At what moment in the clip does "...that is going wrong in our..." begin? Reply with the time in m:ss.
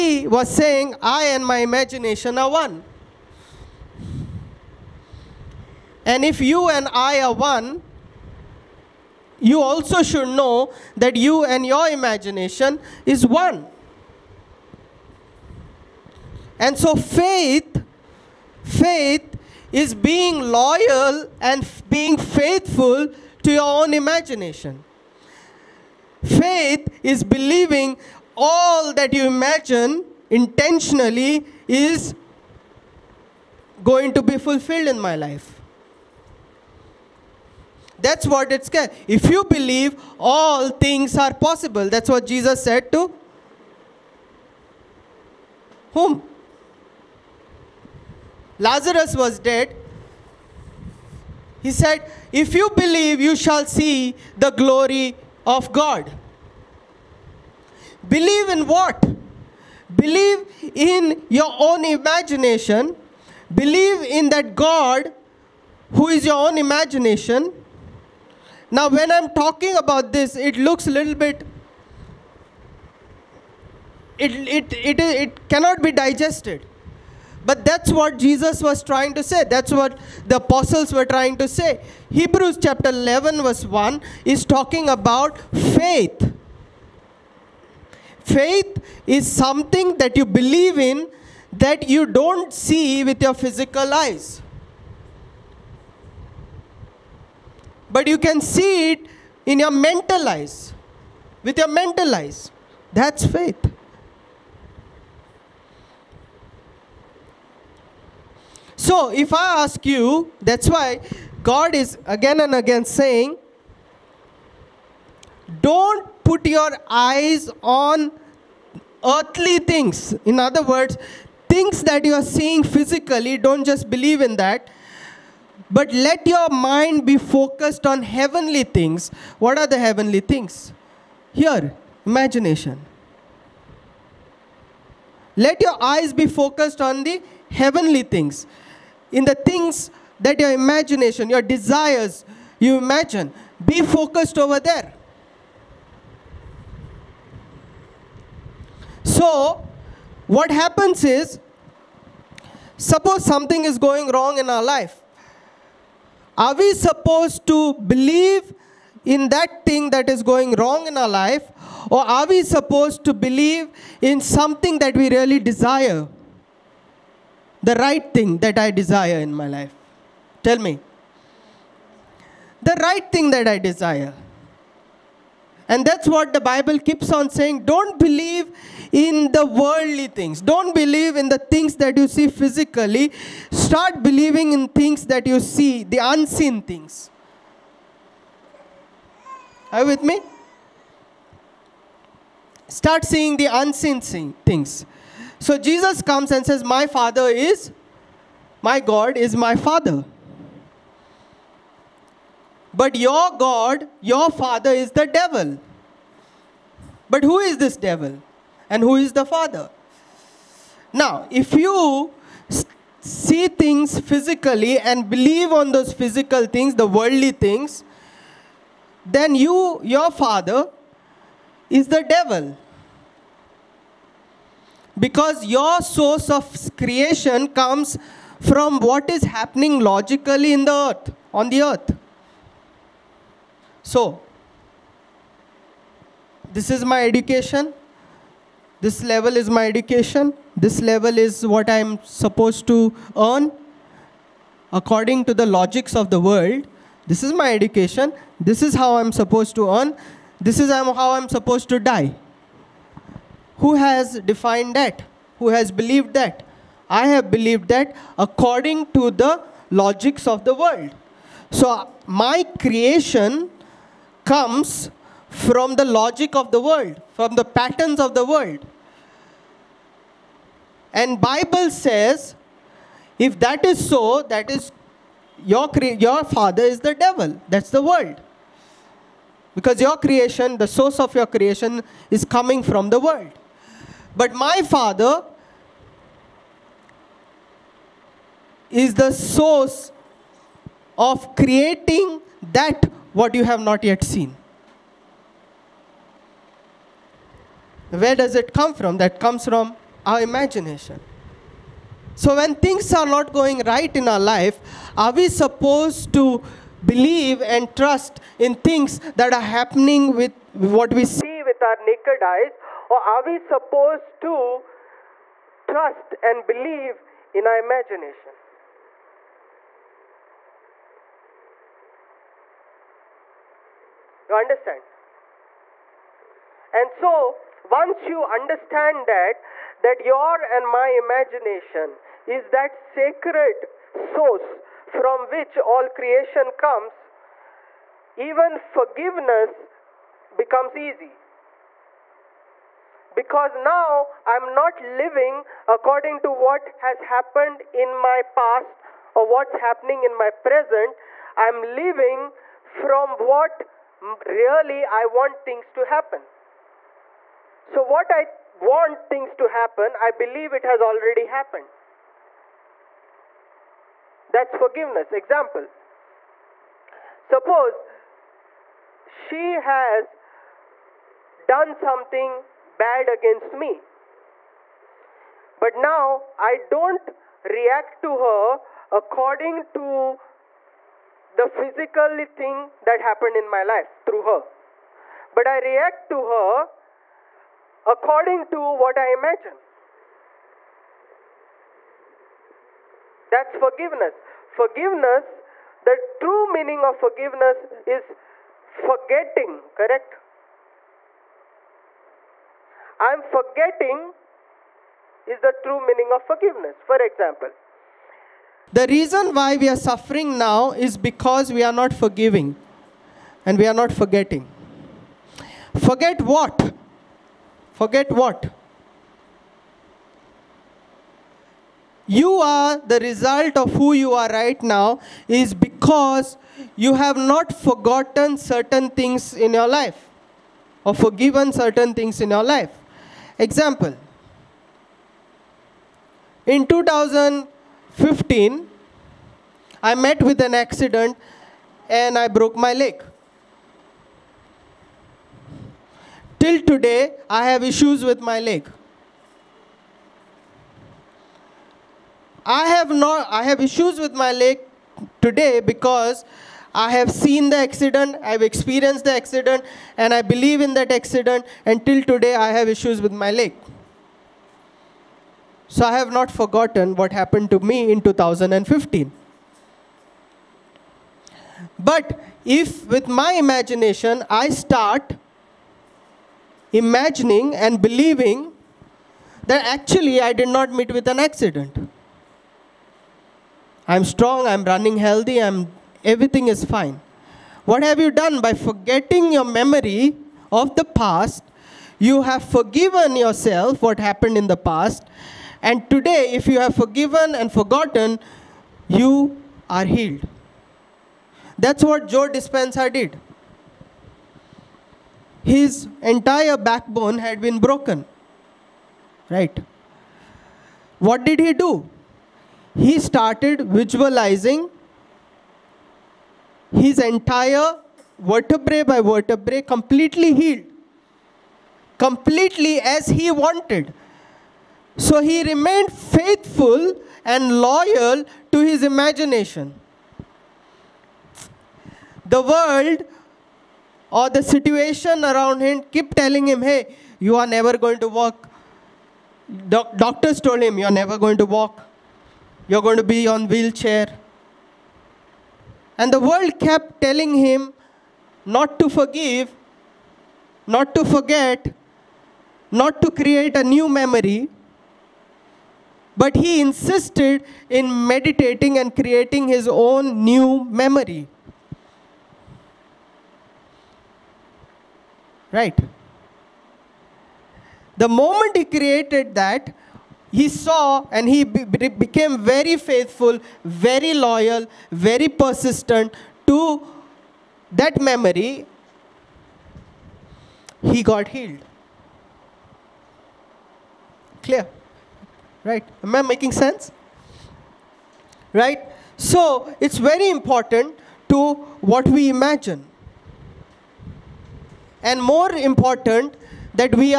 2:39.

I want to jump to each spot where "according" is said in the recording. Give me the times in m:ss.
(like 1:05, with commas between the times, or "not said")
4:04, 4:18, 5:45, 6:18, 6:27.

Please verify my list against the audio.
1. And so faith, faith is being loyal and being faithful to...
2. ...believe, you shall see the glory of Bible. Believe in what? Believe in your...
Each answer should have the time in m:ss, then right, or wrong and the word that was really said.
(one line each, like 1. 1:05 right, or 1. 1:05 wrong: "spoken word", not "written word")
1. 0:16 right
2. 0:52 wrong: "God", not "Bible".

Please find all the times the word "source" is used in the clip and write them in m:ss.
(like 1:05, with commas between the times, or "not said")
3:45, 4:40, 4:49, 5:33.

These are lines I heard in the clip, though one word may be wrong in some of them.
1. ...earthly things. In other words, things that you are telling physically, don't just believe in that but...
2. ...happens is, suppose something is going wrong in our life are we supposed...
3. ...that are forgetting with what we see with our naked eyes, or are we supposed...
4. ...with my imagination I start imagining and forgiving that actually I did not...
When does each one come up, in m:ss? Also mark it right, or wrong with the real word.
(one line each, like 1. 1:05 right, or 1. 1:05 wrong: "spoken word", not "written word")
1. 1:59 wrong: "seeing", not "telling"
2. 2:30 right
3. 5:09 wrong: "happening", not "forgetting"
4. 7:52 wrong: "believing", not "forgiving".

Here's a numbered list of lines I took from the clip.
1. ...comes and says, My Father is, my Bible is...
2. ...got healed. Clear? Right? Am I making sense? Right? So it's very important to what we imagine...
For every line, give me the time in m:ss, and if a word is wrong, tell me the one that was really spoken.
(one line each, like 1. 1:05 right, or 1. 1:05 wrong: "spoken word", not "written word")
1. 3:16 wrong: "God", not "Bible"
2. 9:41 right.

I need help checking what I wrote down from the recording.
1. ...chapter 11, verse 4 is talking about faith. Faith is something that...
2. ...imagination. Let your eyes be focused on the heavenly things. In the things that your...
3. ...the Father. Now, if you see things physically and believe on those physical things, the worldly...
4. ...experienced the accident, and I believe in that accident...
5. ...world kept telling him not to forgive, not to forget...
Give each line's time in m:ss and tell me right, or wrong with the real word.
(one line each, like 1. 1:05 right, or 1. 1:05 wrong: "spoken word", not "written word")
1. 1:22 wrong: "1", not "4"
2. 2:12 right
3. 3:29 right
4. 7:38 right
5. 9:06 right.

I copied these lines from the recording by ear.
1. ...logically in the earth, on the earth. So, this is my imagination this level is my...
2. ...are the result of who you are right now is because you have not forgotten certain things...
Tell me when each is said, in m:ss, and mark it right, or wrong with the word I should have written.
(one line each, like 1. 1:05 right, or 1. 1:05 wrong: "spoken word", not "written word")
1. 3:49 wrong: "education", not "imagination"
2. 7:02 right.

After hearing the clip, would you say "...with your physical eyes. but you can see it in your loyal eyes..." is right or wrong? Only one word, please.
wrong.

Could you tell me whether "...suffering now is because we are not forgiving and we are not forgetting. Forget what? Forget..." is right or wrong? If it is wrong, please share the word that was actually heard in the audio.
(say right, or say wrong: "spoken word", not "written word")
right.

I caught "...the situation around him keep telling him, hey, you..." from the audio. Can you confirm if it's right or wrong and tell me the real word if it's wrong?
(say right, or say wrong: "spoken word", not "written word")
right.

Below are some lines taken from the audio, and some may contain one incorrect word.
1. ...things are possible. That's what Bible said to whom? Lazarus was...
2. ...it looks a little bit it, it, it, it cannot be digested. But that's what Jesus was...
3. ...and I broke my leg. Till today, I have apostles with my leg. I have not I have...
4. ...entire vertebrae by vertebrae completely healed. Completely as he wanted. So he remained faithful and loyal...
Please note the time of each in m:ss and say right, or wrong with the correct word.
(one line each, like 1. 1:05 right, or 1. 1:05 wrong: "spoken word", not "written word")
1. 0:40 wrong: "Jesus", not "Bible"
2. 1:10 right
3. 7:21 wrong: "issues", not "apostles"
4. 8:36 right.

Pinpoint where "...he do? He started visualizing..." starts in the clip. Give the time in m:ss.
8:31.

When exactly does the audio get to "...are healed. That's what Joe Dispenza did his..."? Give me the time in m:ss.
8:19.